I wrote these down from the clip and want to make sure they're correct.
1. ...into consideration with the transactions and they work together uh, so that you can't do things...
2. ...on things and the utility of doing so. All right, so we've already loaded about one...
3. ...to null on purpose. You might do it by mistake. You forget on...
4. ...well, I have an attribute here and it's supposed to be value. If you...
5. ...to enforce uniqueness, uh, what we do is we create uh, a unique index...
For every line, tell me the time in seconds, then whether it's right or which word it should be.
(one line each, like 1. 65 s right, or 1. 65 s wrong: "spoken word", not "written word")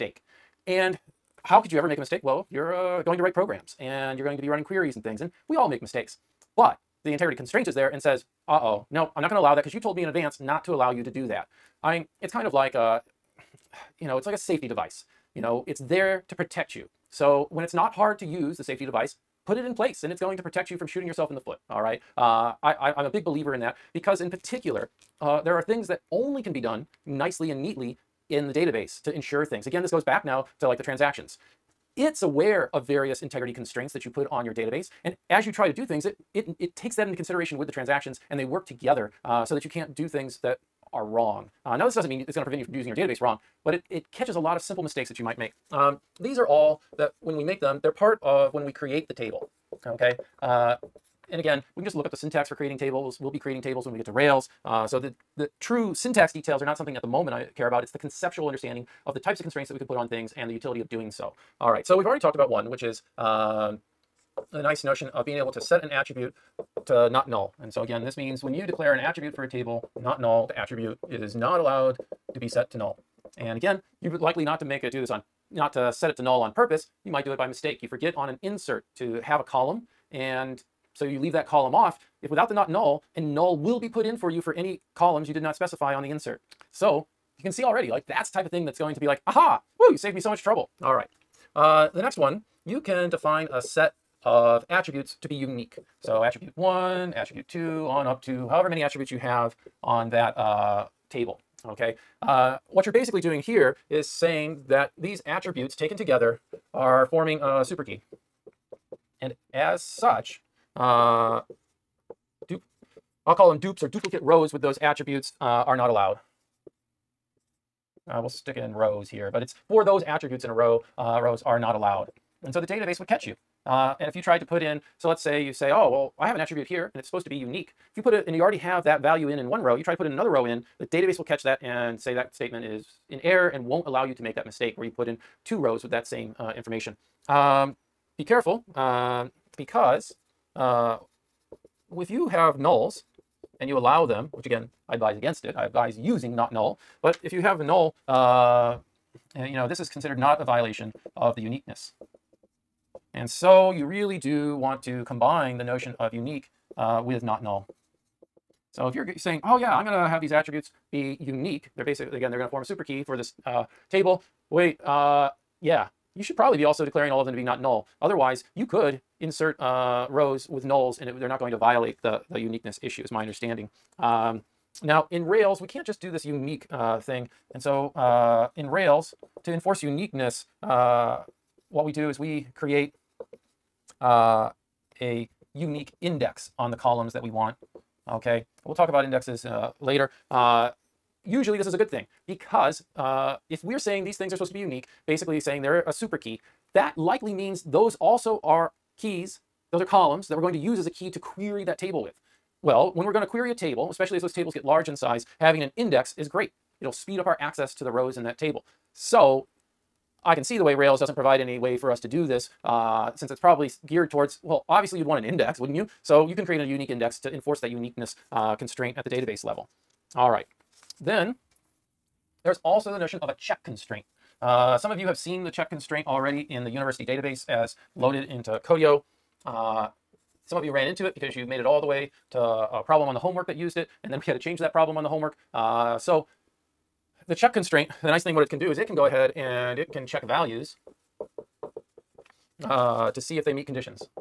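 1. 37 s right
2. 59 s wrong: "talked", not "loaded"
3. 76 s right
4. 125 s wrong: "unique", not "value"
5. 179 s right.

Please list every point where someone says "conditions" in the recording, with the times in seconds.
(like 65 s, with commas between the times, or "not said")
243 s.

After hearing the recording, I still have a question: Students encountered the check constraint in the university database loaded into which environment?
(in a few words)
Codio.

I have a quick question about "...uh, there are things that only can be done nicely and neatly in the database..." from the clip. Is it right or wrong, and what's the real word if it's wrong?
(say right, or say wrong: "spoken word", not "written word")
right.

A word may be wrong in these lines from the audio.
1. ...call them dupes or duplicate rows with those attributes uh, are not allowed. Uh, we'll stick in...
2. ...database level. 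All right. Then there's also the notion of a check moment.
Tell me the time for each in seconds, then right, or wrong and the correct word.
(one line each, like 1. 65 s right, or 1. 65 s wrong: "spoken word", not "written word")
1. 113 s right
2. 219 s wrong: "constraint", not "moment".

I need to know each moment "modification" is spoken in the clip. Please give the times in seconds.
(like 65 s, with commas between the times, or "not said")
not said.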